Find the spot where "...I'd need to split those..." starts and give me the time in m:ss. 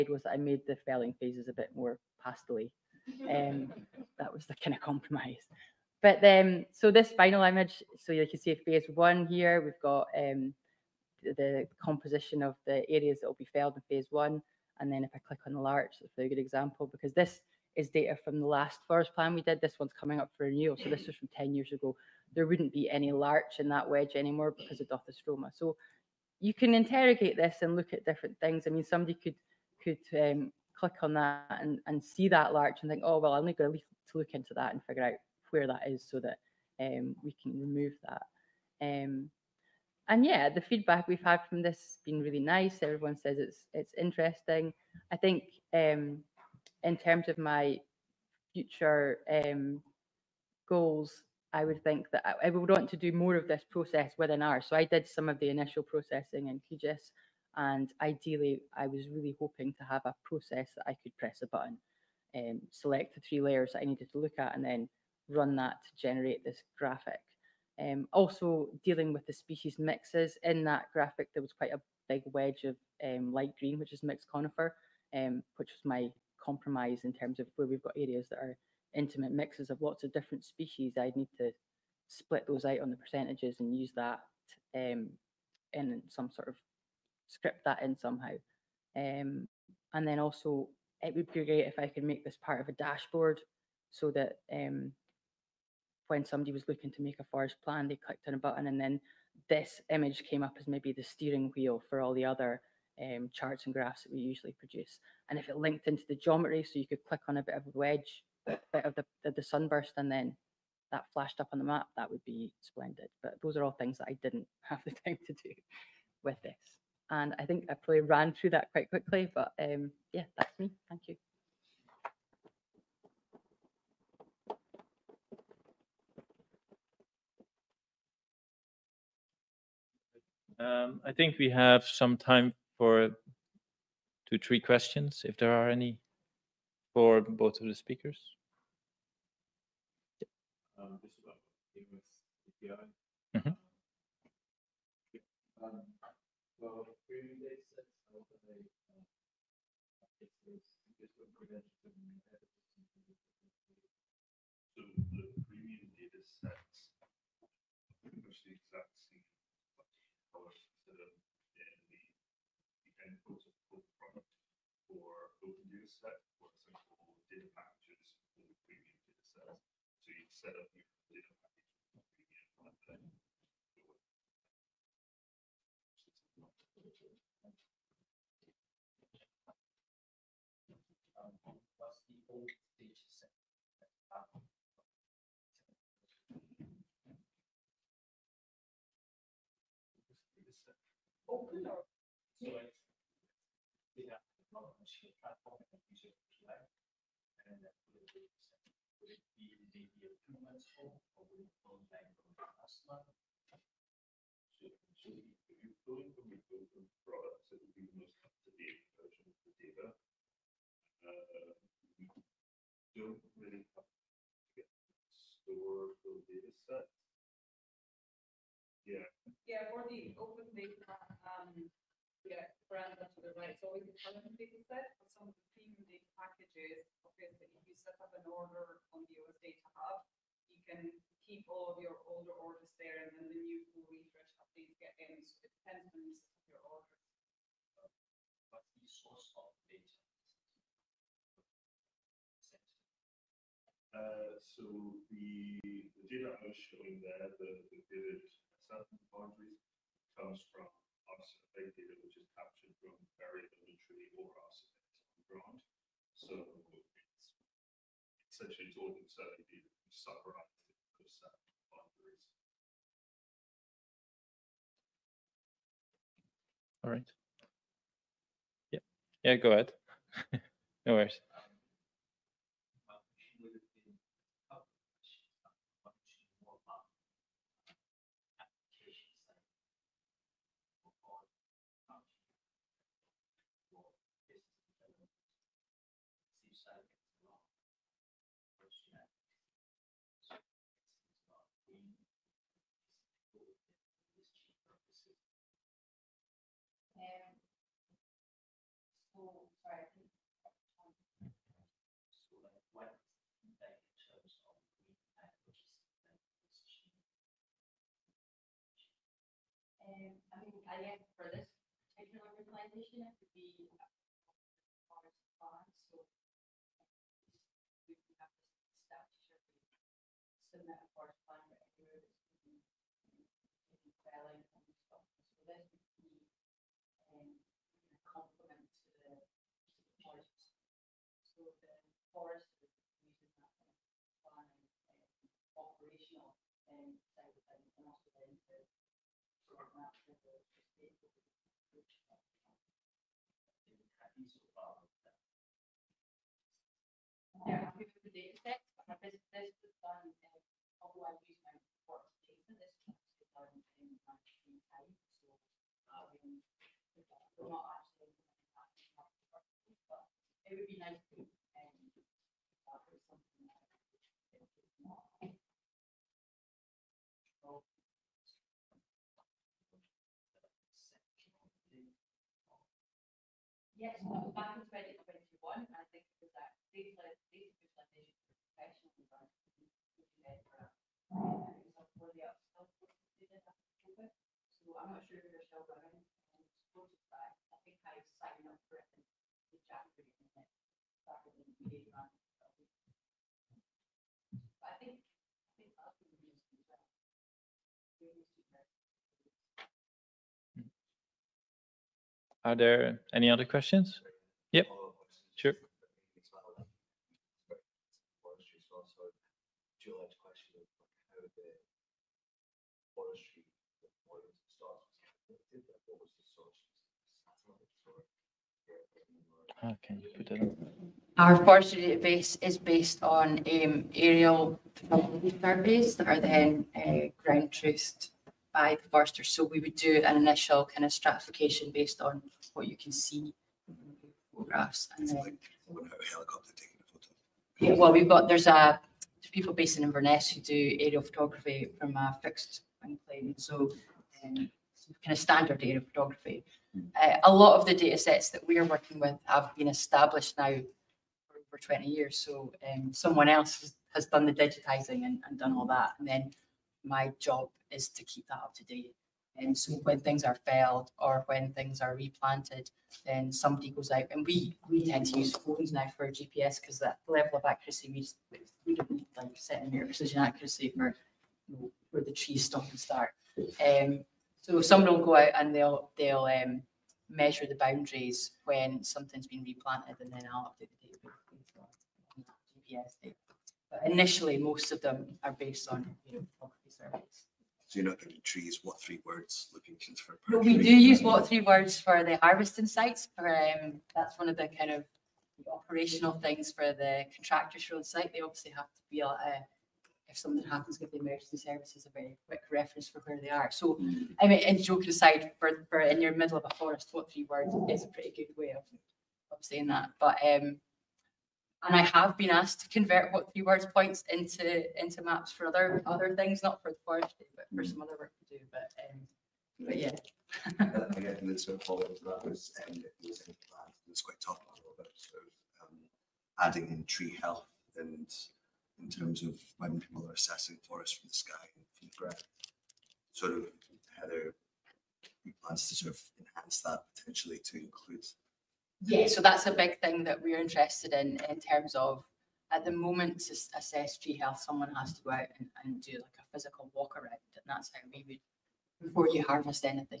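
1:20.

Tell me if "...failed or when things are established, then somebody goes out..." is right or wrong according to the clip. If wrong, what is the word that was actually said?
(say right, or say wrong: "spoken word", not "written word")
wrong: "replanted", not "established".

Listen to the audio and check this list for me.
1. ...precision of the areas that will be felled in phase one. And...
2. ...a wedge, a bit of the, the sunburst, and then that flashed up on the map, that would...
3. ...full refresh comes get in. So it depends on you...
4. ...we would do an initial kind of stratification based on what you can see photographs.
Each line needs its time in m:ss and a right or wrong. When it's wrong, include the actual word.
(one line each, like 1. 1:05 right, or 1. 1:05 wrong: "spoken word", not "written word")
1. 0:11 wrong: "composition", not "precision"
2. 1:47 right
3. 3:53 wrong: "updates", not "comes"
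4. 7:09 right.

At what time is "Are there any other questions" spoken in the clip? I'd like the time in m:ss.
6:42.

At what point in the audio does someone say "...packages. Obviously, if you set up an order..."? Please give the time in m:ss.
3:46.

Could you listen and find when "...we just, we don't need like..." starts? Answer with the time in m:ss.
7:47.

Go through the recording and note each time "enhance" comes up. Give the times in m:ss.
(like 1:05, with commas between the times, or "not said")
8:56.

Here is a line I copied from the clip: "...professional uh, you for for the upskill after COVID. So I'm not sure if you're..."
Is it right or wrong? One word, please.
right.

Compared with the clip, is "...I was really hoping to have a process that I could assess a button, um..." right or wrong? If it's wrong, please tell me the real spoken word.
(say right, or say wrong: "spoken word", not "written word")
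wrong: "press", not "assess".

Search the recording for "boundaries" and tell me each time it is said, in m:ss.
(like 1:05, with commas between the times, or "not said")
4:09, 7:57.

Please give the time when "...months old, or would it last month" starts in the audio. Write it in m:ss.
3:20.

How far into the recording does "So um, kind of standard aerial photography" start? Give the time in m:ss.
7:23.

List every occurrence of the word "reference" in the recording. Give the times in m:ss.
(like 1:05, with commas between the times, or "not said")
8:22.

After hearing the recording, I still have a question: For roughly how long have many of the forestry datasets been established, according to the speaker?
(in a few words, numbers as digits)
Over 20 years.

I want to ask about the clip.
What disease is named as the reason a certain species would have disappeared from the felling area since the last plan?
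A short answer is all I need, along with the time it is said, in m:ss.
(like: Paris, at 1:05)
Dothistroma, at 0:24.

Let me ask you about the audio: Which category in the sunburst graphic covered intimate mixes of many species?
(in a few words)
Mixed conifer.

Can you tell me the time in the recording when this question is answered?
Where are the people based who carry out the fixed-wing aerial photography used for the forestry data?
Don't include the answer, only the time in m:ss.
7:19.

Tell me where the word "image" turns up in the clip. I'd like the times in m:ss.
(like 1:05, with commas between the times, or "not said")
0:07, 1:39.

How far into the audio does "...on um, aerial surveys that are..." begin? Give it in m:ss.
7:03.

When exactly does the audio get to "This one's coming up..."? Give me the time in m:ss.
0:19.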